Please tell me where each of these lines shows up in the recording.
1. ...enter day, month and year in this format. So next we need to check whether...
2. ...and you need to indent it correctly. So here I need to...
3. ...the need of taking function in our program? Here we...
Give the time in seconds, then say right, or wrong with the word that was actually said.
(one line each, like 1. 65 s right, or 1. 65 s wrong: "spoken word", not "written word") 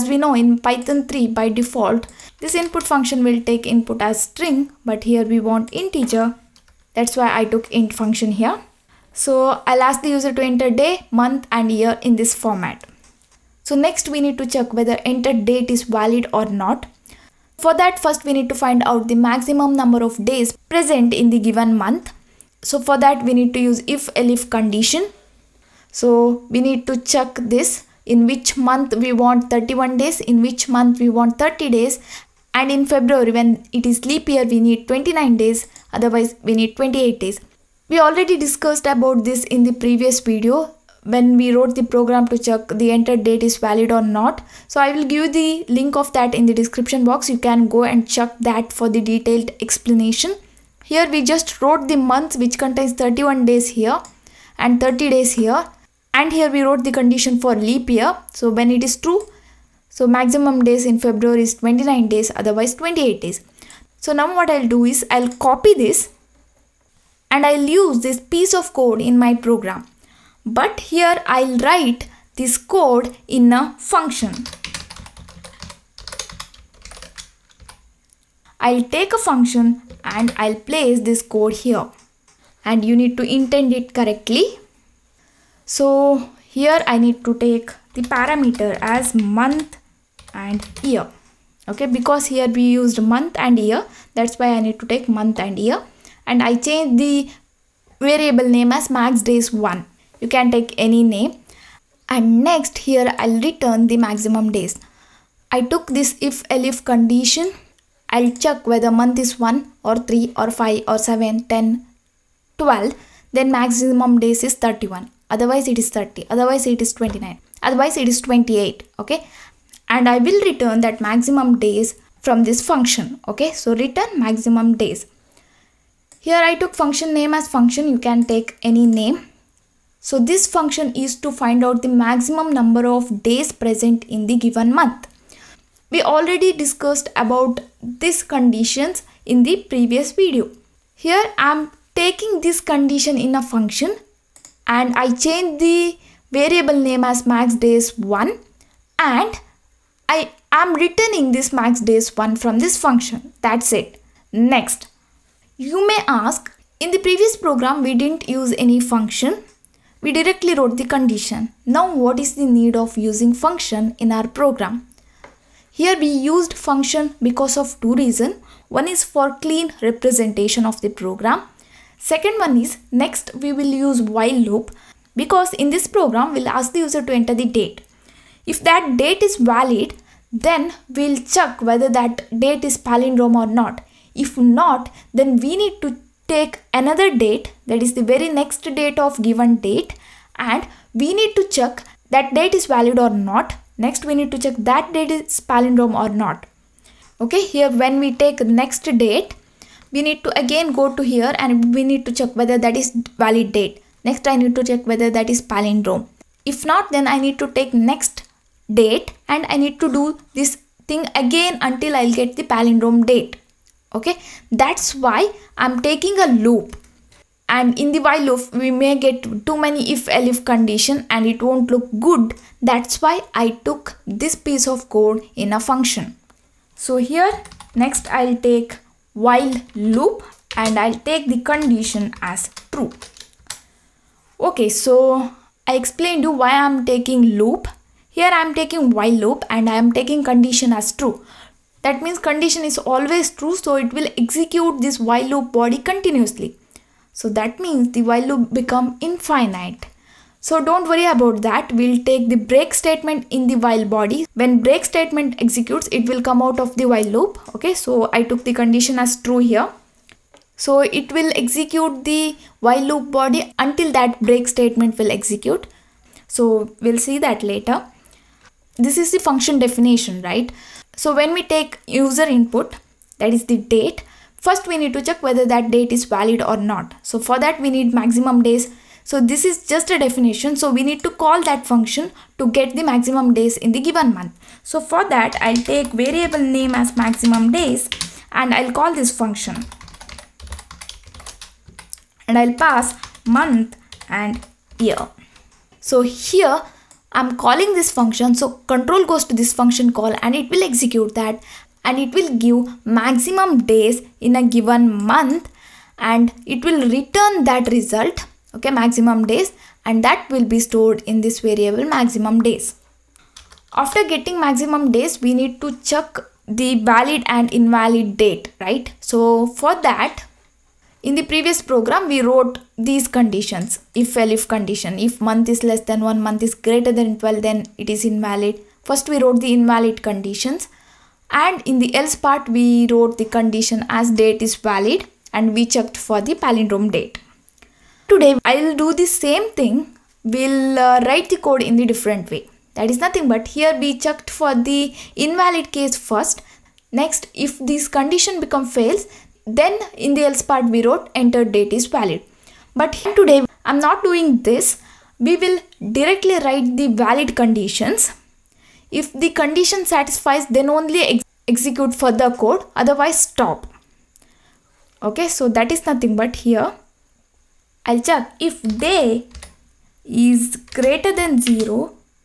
1. 10 s right
2. 82 s right
3. 162 s wrong: "using", not "taking".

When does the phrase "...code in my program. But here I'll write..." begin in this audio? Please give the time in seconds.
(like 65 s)
68 s.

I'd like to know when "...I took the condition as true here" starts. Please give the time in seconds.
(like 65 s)
258 s.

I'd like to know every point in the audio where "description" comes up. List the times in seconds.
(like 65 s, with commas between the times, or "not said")
46 s.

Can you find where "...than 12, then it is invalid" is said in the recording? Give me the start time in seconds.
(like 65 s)
326 s.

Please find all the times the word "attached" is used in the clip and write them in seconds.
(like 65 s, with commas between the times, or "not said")
not said.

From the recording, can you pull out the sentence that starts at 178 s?
If that date is valid then we'll check whether that date is palindrome or not.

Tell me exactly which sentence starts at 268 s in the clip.
This is the function definition, right?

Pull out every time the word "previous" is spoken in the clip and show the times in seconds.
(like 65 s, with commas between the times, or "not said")
39 s, 139 s, 157 s, 321 s.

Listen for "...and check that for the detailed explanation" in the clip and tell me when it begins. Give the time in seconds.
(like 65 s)
47 s.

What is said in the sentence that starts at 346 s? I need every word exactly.
Next, if this condition become fails, then in the else part we wrote enter date is valid.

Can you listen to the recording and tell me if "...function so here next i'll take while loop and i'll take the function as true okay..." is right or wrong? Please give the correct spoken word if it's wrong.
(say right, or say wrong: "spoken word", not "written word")
wrong: "condition", not "function".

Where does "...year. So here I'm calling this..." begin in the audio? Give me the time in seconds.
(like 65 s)
294 s.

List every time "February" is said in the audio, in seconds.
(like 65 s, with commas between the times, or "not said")
32 s, 61 s.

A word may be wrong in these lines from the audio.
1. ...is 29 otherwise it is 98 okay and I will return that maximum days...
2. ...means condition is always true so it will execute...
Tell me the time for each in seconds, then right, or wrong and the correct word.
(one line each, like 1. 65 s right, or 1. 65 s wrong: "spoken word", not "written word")
1. 116 s wrong: "28", not "98"
2. 242 s right.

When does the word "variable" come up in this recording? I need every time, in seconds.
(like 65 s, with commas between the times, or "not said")
98 s, 146 s, 285 s, 311 s.